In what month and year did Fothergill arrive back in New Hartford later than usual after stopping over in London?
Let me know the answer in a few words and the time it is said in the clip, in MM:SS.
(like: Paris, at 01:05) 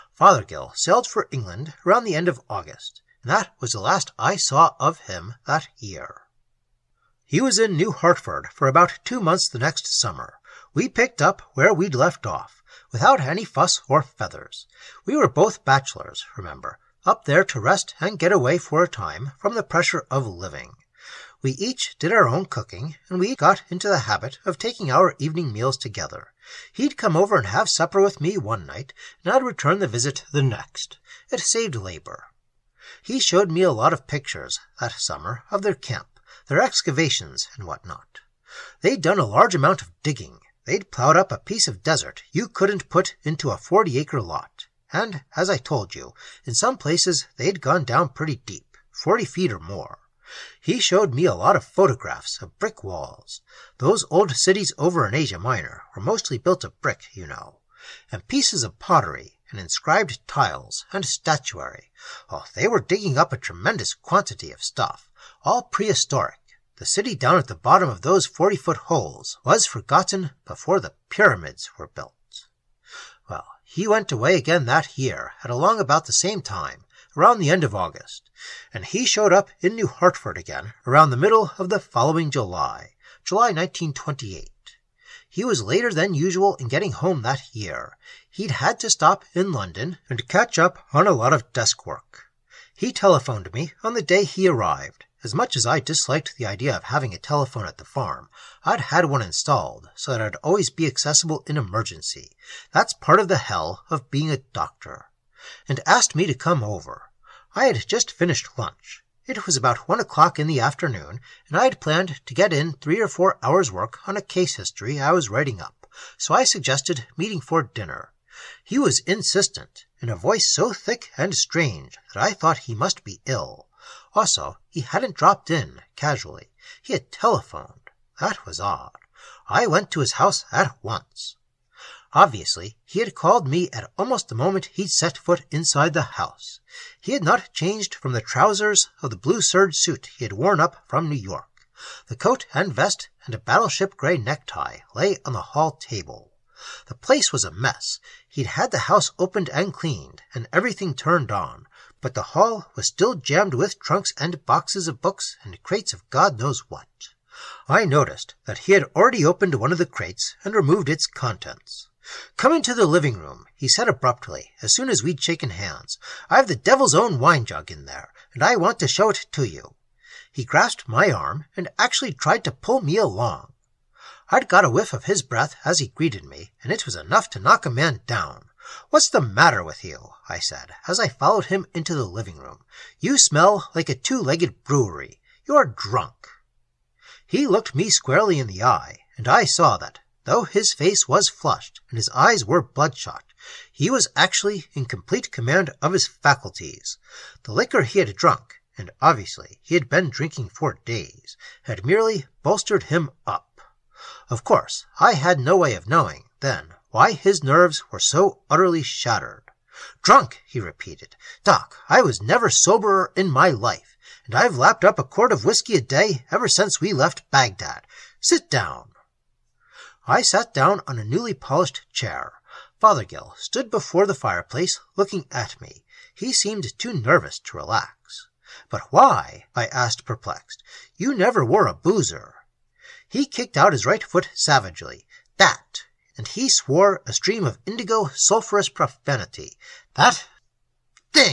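July 1928, at 01:23.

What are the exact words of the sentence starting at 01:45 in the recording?
And asked me to come over.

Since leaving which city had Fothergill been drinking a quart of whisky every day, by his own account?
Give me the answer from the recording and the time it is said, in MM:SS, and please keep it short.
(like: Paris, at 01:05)
Baghdad, at 03:37.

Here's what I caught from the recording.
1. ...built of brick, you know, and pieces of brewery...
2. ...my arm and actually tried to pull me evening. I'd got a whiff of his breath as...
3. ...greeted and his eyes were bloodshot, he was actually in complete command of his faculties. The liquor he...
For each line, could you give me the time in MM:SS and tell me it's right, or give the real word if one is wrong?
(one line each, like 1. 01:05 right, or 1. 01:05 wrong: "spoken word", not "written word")
1. 00:56 wrong: "pottery", not "brewery"
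2. 02:50 wrong: "along", not "evening"
3. 03:11 wrong: "flushed", not "greeted".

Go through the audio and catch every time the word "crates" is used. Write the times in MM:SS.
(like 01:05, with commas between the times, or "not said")
02:35, 02:39.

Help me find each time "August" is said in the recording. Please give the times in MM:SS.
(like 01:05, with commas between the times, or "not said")
00:02, 01:17.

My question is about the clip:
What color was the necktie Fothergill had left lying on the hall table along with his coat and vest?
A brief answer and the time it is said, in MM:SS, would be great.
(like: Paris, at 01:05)
battleship gray, at 02:23.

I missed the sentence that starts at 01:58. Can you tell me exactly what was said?
He was insistent, in a voice so thick and strange that I thought he must be ill.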